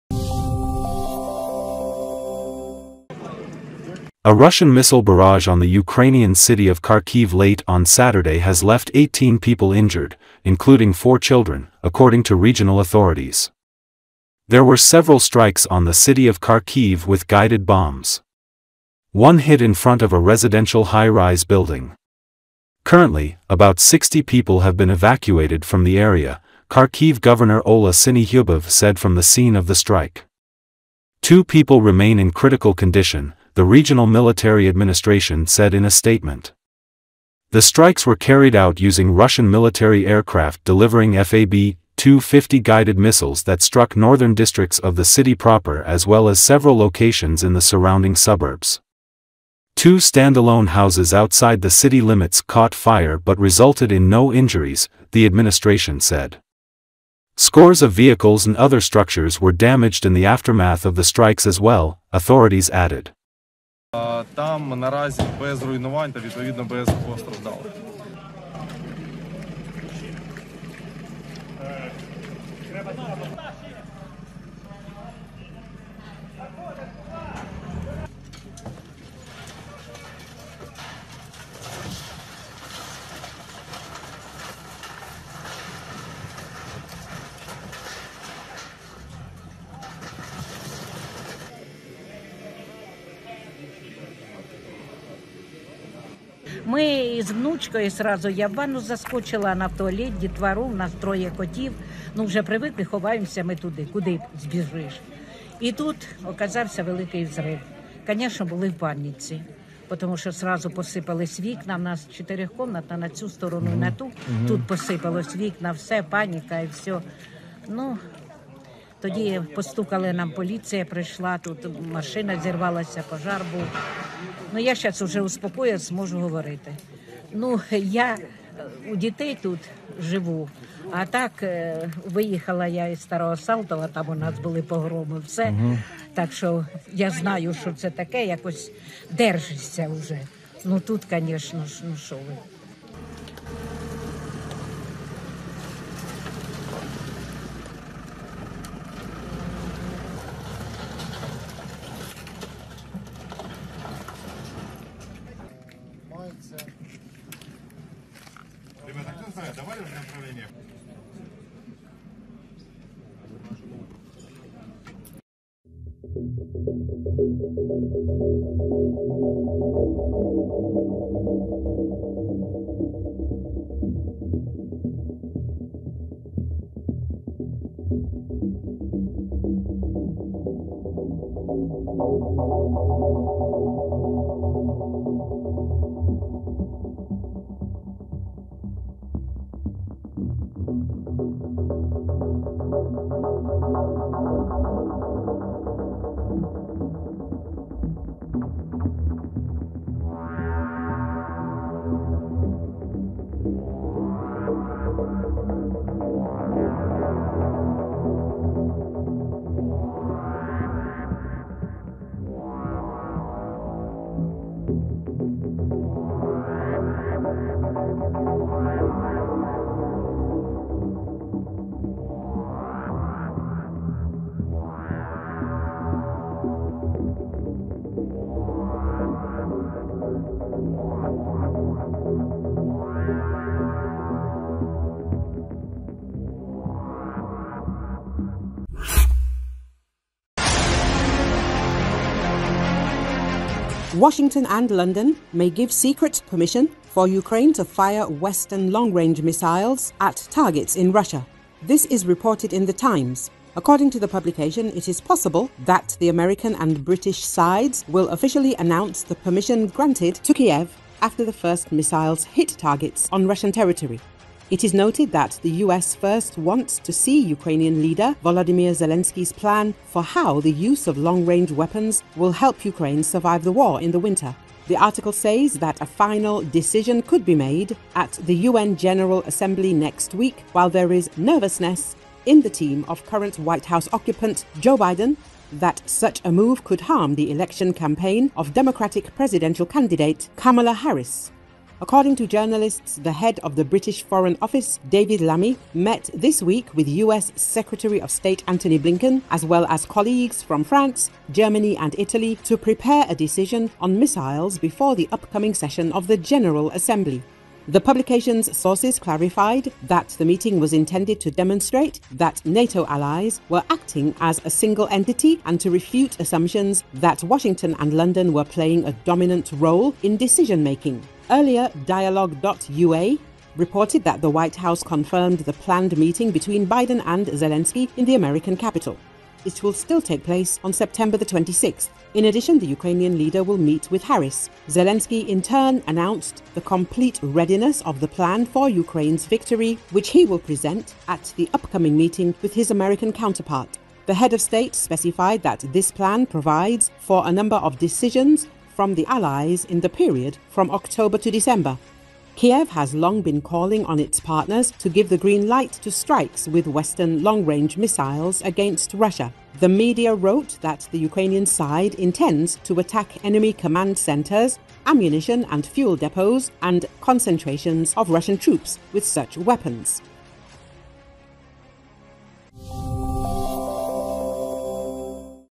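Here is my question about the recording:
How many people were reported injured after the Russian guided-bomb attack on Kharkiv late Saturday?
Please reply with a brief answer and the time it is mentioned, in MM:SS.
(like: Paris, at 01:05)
18, at 00:08.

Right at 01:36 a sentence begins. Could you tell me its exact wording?
Ми з внучкою сразу я в ванну заскочила на в туалет, дітвору, в нас троє котів.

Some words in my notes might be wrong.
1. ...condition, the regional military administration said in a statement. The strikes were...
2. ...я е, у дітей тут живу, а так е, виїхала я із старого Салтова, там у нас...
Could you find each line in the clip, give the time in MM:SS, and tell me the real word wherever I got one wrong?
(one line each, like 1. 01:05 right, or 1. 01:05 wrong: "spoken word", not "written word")
1. 00:32 right
2. 02:07 right.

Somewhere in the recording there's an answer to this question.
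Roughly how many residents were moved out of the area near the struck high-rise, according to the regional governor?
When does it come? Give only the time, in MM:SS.
00:23.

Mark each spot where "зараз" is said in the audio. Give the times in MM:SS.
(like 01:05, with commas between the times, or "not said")
02:04.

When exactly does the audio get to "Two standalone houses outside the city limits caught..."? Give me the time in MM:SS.
00:49.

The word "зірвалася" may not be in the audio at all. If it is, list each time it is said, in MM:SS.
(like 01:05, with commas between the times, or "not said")
02:02.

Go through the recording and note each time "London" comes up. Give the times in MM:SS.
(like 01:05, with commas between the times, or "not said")
04:04, 05:17.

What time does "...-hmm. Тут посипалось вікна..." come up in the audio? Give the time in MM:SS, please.
01:54.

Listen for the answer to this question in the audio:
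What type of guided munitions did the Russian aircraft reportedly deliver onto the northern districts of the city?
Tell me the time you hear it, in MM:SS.
00:41.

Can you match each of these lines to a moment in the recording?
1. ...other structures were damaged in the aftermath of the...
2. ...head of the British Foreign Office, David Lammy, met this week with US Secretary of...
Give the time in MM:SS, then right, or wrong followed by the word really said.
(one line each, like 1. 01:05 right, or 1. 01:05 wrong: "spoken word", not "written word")
1. 00:58 right
2. 04:53 right.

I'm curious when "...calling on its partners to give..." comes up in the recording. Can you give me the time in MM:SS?
05:53.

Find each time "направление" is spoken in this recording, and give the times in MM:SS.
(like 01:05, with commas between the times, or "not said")
02:39.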